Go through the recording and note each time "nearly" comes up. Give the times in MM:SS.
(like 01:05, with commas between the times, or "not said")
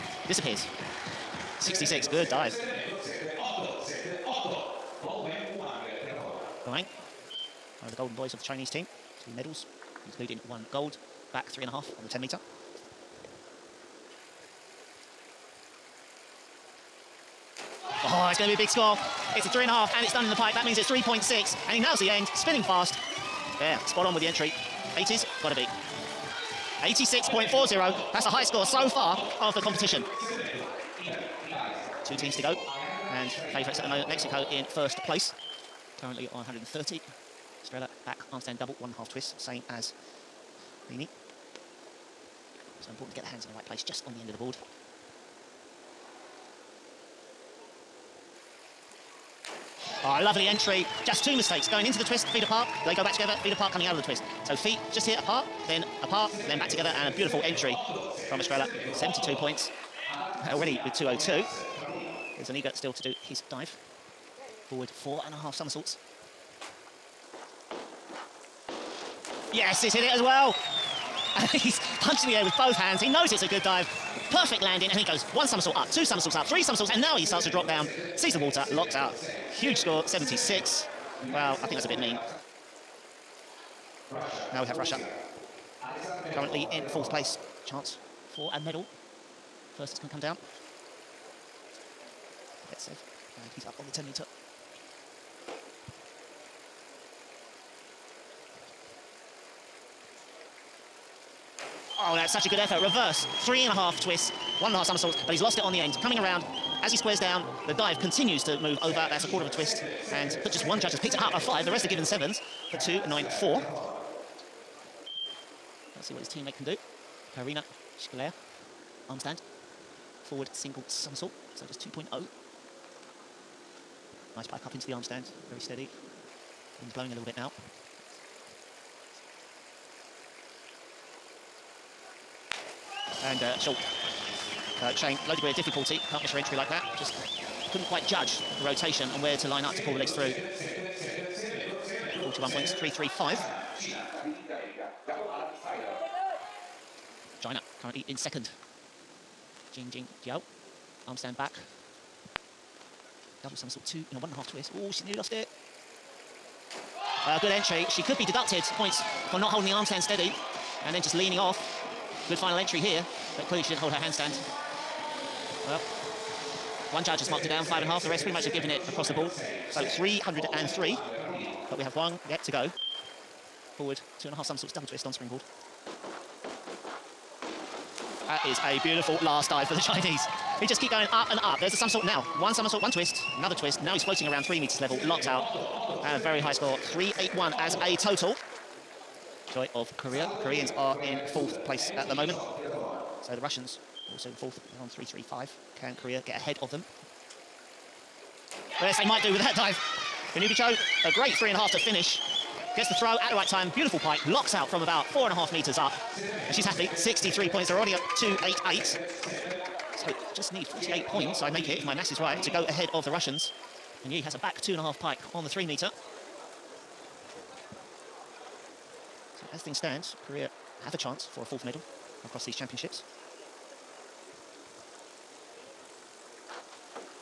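02:35.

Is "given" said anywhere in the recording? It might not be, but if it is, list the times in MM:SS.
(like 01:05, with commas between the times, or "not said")
01:51, 02:48.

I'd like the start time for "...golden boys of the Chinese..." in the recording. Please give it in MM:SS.
00:07.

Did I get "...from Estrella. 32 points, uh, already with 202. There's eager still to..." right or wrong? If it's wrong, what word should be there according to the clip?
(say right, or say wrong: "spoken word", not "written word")
wrong: "72", not "32".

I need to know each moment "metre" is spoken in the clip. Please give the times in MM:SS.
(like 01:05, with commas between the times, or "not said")
00:12, 01:34, 03:04, 03:25, 03:35.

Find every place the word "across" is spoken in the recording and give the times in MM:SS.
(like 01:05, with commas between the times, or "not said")
02:48, 03:42.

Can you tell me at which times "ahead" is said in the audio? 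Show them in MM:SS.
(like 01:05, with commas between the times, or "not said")
03:16, 03:32.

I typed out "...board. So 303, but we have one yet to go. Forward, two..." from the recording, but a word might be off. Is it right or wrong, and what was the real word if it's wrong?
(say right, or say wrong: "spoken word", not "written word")
right.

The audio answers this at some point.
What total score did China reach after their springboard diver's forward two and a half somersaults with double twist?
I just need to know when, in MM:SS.
03:06.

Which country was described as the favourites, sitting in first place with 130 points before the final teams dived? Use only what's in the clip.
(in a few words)
Mexico.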